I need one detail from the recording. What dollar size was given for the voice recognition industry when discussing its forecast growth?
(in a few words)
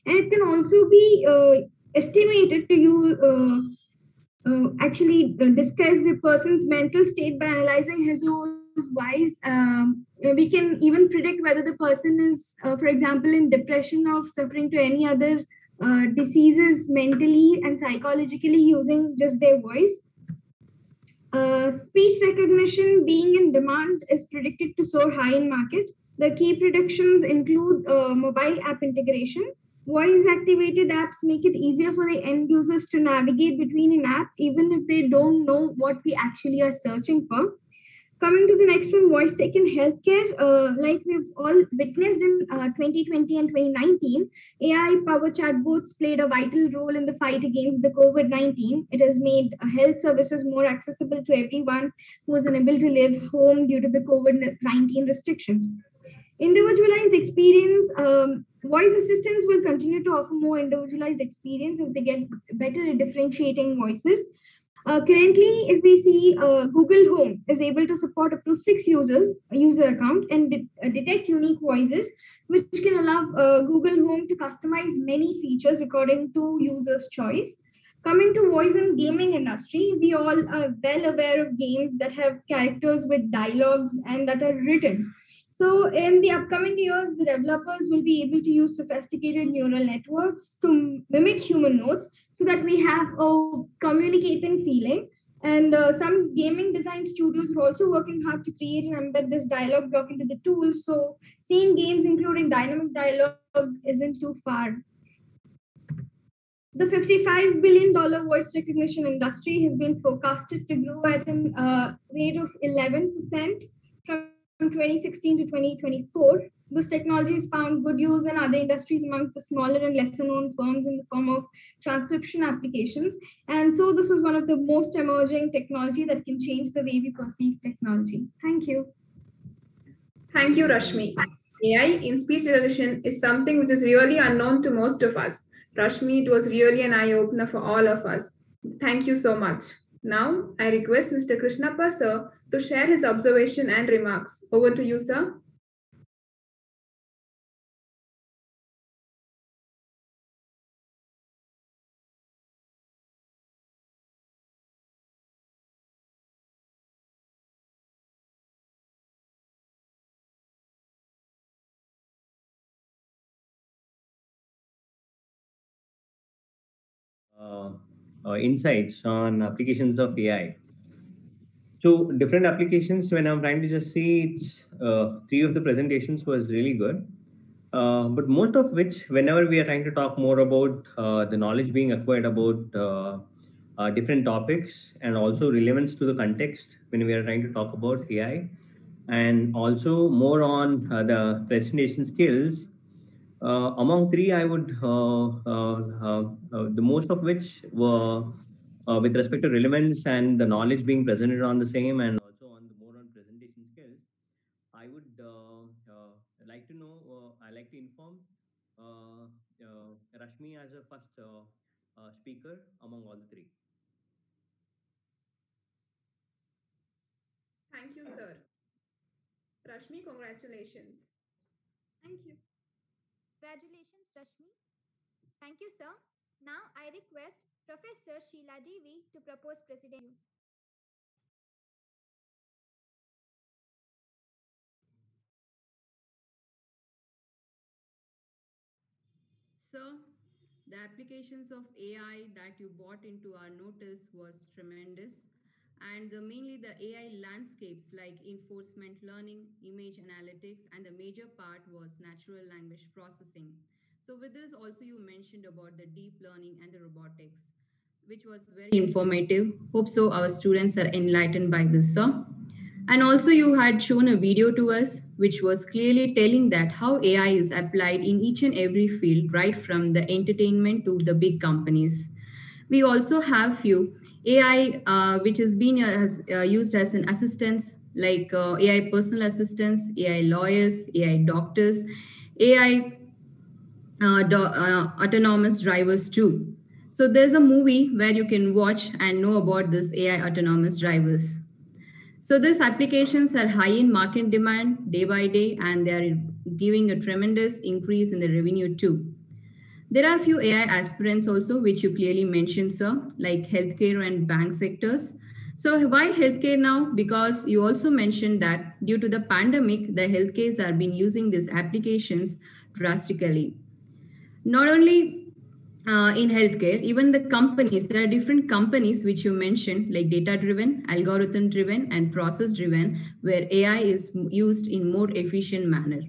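$55 billion.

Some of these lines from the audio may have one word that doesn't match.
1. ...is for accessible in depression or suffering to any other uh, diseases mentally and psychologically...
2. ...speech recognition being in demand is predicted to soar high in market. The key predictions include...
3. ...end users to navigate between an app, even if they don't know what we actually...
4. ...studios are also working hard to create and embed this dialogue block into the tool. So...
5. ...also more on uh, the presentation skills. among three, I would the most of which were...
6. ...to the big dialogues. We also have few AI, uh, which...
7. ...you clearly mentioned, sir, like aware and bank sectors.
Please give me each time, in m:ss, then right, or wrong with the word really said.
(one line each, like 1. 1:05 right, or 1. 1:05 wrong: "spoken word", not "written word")
1. 0:12 wrong: "example", not "accessible"
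2. 0:21 right
3. 0:32 right
4. 1:37 right
5. 3:09 right
6. 4:30 wrong: "companies", not "dialogues"
7. 5:01 wrong: "healthcare", not "aware".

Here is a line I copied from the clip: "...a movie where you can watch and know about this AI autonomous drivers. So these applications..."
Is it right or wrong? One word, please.
right.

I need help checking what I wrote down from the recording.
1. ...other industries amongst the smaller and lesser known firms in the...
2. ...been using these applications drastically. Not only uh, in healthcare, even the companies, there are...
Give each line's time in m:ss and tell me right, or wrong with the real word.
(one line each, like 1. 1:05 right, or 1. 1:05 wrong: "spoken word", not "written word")
1. 1:58 right
2. 5:10 right.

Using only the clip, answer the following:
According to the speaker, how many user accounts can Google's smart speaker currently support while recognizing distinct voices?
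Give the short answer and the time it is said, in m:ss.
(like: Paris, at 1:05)
6, at 1:08.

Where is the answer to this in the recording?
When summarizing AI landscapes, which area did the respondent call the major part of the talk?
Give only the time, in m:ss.
4:12.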